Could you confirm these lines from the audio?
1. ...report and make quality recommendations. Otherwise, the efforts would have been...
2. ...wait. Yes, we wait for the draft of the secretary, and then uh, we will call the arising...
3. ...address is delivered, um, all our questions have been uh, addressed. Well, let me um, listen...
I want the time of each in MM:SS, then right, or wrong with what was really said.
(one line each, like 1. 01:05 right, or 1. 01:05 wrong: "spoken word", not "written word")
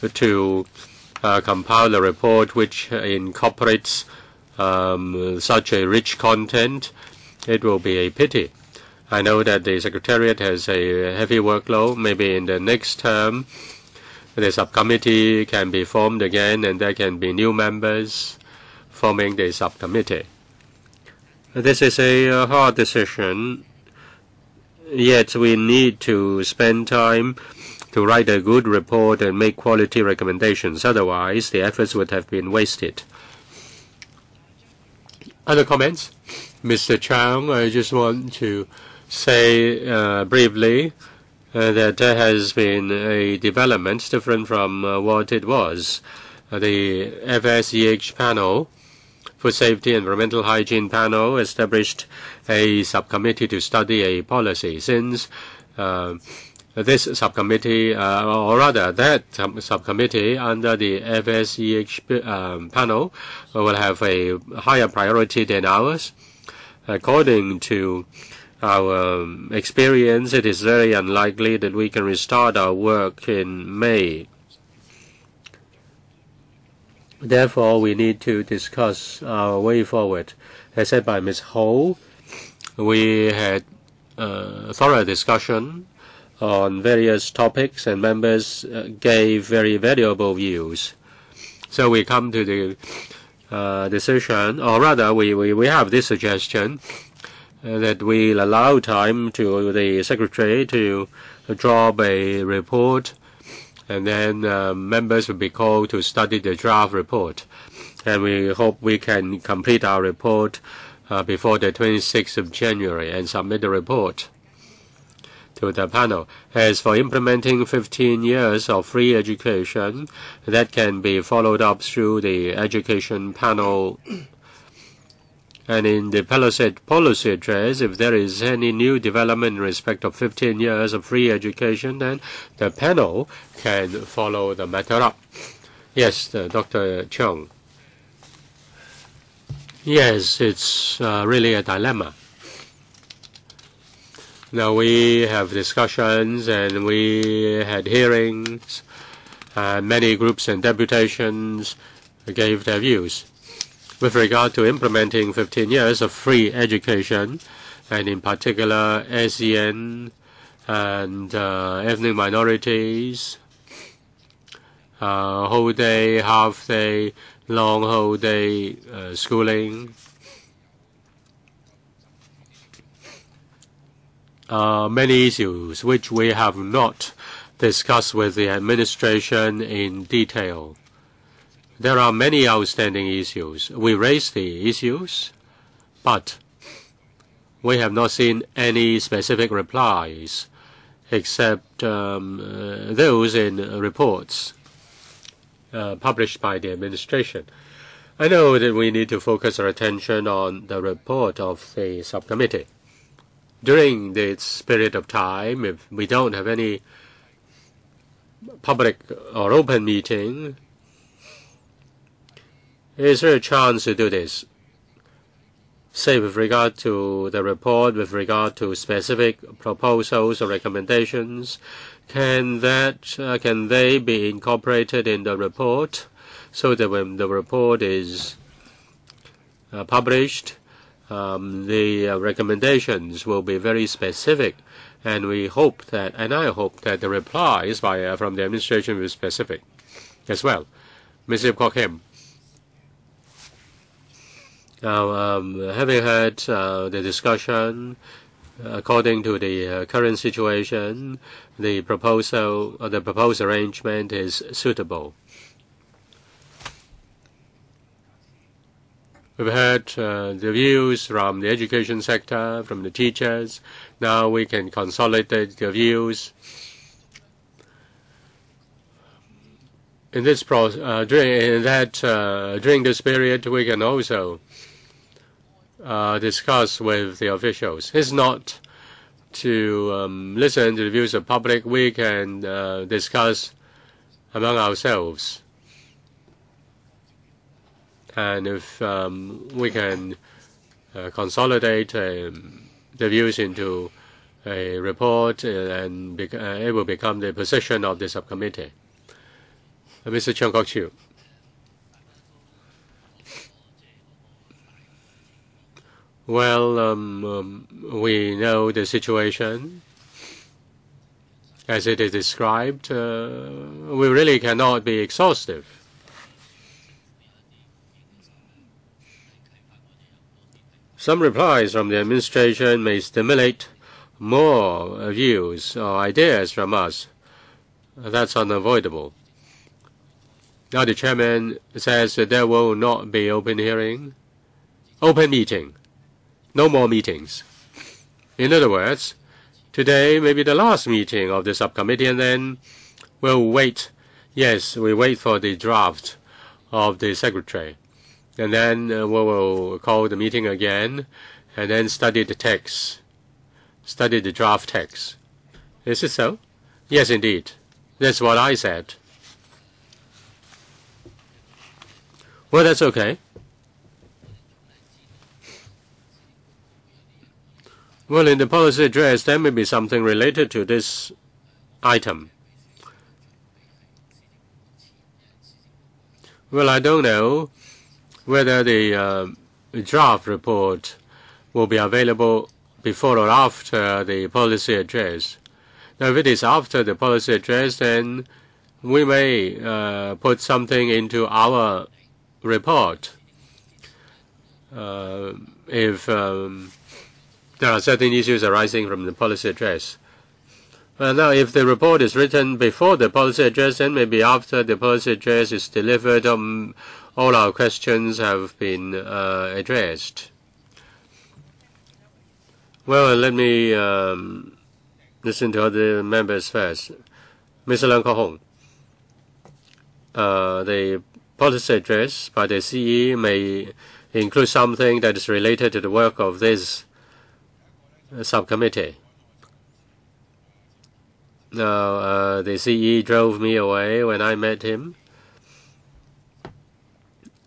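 1. 00:28 right
2. 05:43 wrong: "meeting", not "arising"
3. 06:45 right.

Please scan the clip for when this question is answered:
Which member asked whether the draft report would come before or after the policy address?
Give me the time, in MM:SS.
05:00.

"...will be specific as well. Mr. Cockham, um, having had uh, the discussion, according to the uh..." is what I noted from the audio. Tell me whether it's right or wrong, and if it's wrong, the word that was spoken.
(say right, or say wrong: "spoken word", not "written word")
right.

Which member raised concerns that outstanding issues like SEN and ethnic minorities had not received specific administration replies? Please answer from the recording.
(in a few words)
Dr. Cheung.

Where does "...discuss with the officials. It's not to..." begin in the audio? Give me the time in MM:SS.
04:36.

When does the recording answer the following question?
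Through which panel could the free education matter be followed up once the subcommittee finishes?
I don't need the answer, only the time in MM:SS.
02:02.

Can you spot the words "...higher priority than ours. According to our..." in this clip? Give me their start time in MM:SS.
01:04.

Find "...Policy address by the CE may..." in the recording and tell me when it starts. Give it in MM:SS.
07:01.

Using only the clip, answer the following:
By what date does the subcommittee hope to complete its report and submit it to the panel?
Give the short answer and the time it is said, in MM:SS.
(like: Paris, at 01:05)
26 January, at 01:51.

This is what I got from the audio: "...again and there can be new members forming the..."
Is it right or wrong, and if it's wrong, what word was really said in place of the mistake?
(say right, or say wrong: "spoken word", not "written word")
right.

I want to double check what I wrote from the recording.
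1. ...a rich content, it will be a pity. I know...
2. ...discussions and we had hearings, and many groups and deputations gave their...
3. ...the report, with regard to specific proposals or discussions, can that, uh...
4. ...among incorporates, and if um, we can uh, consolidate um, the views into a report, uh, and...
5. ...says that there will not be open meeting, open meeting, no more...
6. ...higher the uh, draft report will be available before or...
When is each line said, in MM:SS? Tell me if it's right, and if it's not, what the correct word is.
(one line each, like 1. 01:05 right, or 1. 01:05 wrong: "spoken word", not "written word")
1. 00:05 right
2. 02:25 right
3. 03:37 wrong: "recommendations", not "discussions"
4. 04:44 wrong: "ourselves", not "incorporates"
5. 05:31 wrong: "hearing", not "meeting"
6. 06:18 wrong: "whether", not "higher".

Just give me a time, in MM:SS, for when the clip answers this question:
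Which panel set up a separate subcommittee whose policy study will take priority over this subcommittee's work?
00:49.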